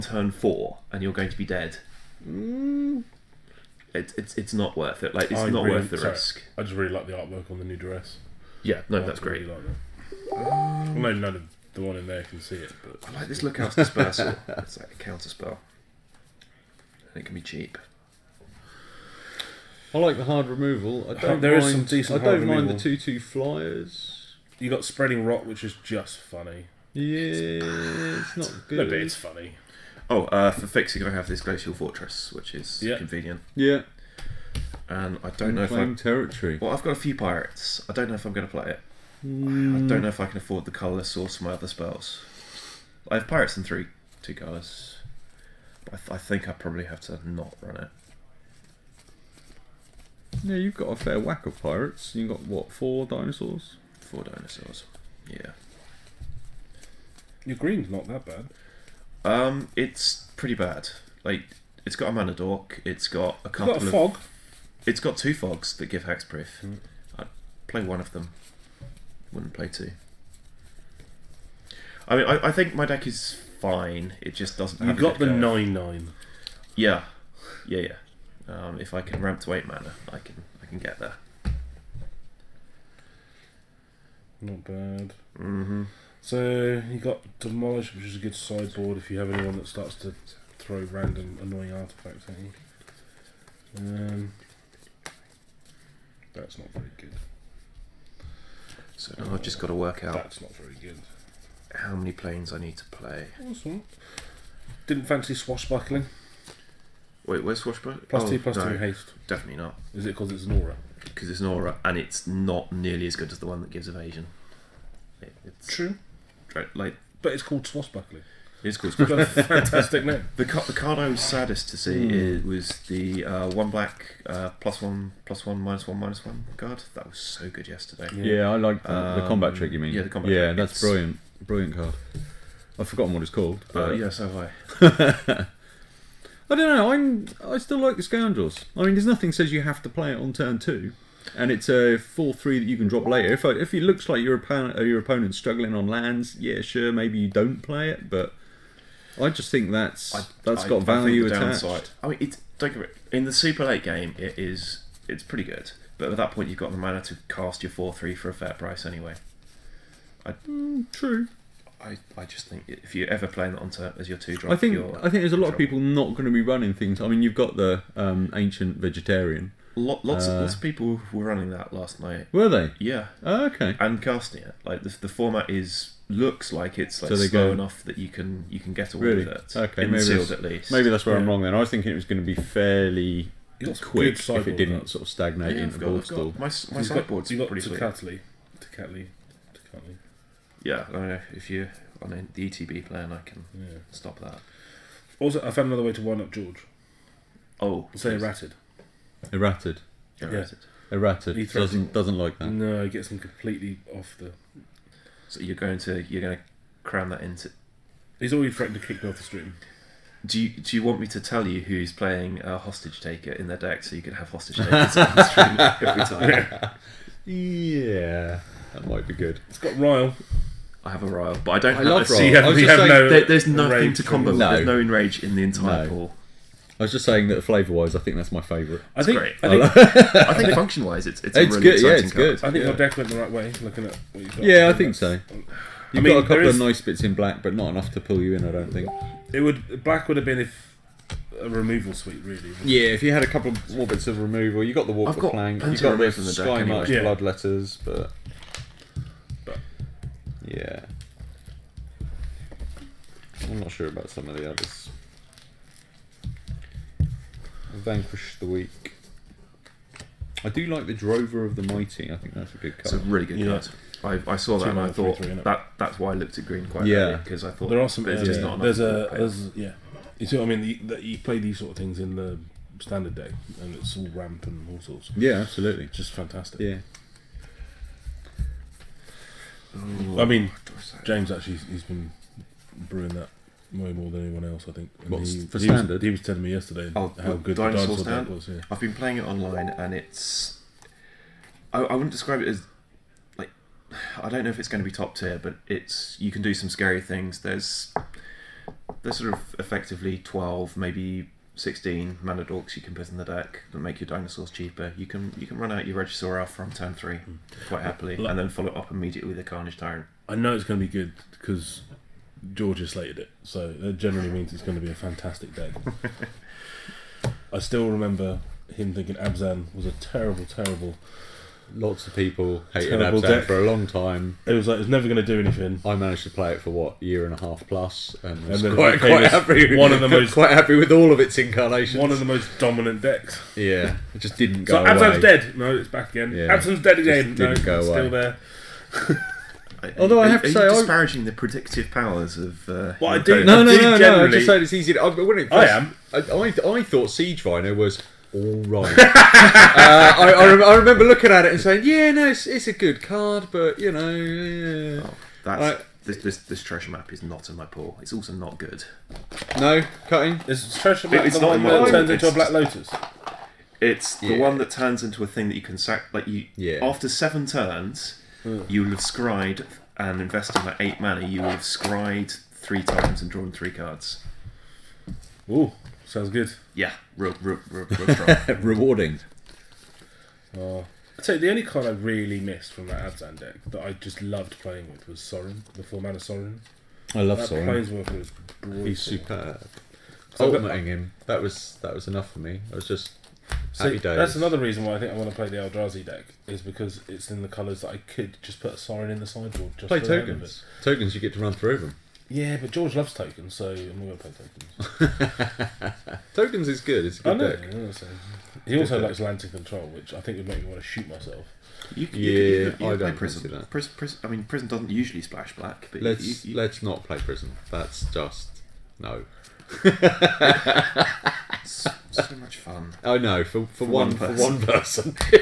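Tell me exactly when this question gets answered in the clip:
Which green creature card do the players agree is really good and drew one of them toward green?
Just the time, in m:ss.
4:20.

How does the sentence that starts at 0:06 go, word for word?
I just really like the artwork on the new dress.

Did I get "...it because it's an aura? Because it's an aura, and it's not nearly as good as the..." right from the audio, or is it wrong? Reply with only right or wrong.
right.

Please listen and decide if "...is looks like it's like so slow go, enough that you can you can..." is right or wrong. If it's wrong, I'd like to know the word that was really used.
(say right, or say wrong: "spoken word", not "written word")
right.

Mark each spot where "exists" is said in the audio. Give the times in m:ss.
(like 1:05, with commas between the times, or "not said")
not said.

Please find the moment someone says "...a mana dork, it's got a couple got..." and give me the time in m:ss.
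1:02.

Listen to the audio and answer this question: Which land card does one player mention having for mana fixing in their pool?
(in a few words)
Glacial Fortress.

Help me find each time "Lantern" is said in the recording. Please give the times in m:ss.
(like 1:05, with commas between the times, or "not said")
6:49.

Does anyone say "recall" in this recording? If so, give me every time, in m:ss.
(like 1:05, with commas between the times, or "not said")
not said.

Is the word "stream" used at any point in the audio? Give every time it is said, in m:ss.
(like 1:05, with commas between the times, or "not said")
3:29, 3:35.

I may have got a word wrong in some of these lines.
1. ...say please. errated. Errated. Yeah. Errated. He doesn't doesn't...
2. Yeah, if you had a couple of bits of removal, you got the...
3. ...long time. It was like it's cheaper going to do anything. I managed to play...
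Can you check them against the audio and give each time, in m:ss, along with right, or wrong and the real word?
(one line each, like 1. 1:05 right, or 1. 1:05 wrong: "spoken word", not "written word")
1. 3:17 right
2. 4:02 right
3. 5:23 wrong: "never", not "cheaper".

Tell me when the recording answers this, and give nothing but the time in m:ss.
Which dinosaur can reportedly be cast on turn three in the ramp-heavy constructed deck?
5:06.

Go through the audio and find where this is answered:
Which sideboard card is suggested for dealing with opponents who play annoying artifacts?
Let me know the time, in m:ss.
1:27.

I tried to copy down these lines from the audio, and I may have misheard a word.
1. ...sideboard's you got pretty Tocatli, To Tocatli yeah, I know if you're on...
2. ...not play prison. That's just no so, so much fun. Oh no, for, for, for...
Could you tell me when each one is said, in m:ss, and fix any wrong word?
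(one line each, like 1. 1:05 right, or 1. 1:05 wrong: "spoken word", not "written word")
1. 3:06 right
2. 6:56 right.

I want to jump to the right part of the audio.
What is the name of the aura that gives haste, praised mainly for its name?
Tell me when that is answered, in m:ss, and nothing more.
1:45.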